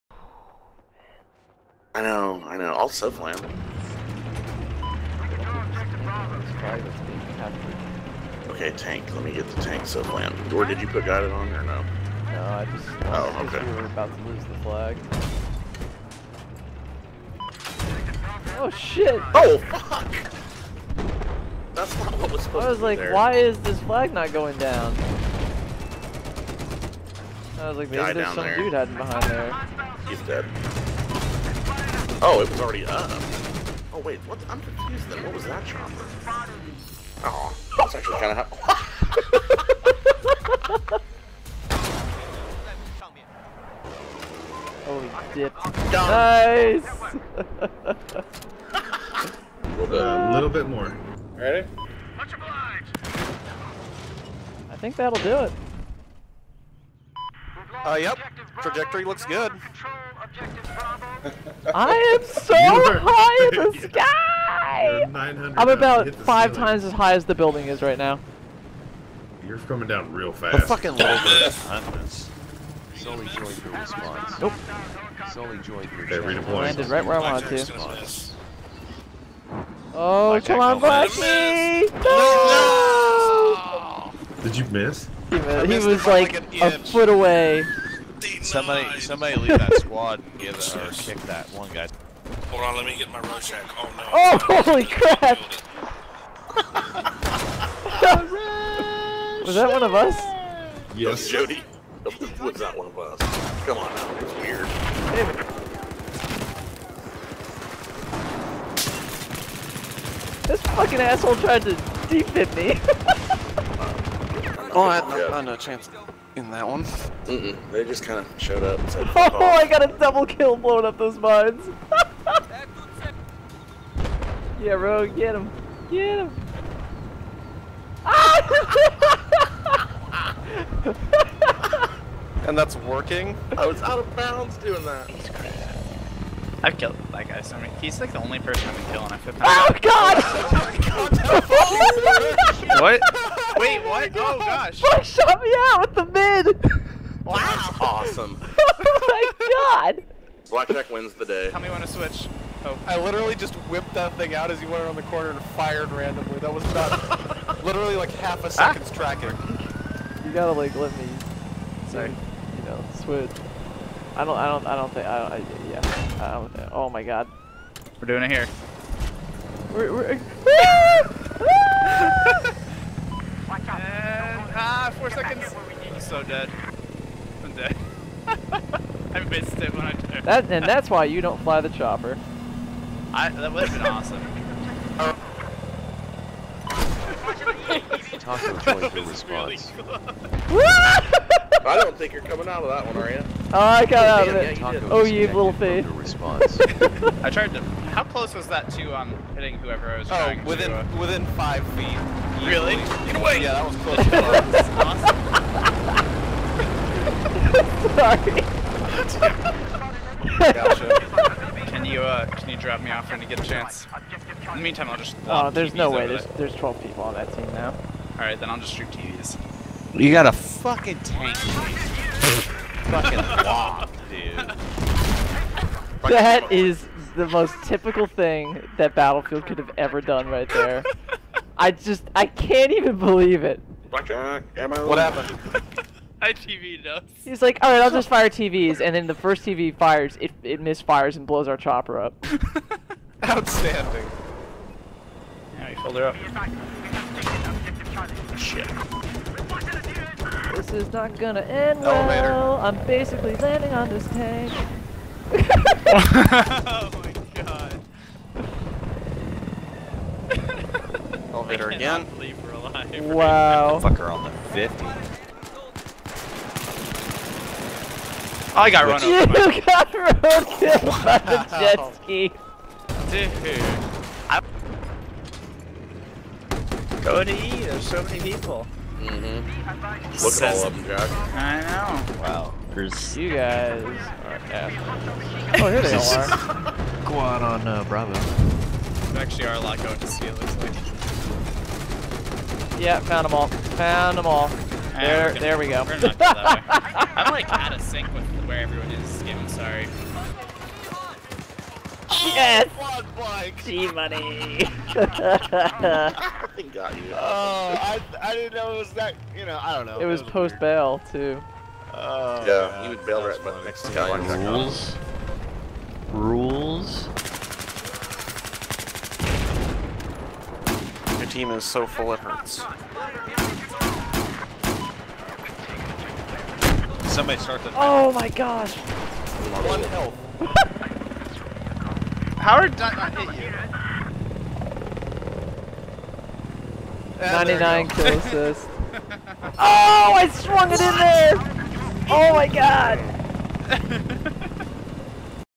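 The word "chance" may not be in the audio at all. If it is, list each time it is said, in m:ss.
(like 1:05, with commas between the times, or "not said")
1:55, 3:33.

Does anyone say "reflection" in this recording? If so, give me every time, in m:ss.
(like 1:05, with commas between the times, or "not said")
not said.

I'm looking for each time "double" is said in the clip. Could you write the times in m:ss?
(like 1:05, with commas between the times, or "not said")
1:59.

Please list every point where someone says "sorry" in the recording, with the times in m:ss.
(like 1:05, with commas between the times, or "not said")
2:41, 3:28, 4:59.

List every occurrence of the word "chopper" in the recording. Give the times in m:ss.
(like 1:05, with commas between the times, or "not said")
0:35, 3:01, 4:01.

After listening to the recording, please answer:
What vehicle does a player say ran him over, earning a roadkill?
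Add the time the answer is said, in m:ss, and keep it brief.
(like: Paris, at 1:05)
jet ski, at 4:31.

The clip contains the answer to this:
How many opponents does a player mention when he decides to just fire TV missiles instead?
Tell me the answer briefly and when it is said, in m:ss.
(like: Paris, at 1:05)
12, at 3:36.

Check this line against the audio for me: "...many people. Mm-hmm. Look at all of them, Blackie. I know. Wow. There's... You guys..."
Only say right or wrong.
wrong.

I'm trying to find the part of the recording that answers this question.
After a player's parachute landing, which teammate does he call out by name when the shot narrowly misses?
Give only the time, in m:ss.
1:20.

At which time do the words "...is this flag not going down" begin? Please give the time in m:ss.
0:23.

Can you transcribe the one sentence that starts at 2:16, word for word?
I've killed that guy so many.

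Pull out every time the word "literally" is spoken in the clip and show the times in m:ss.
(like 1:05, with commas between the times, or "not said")
2:33, 2:37.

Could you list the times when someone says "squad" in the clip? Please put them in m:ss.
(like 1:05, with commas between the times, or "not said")
1:29, 4:47.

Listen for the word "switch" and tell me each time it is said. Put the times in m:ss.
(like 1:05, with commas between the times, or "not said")
2:31, 2:43.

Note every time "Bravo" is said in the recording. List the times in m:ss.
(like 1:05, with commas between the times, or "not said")
4:47.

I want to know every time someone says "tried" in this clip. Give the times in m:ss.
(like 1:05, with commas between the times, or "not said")
1:51, 3:17.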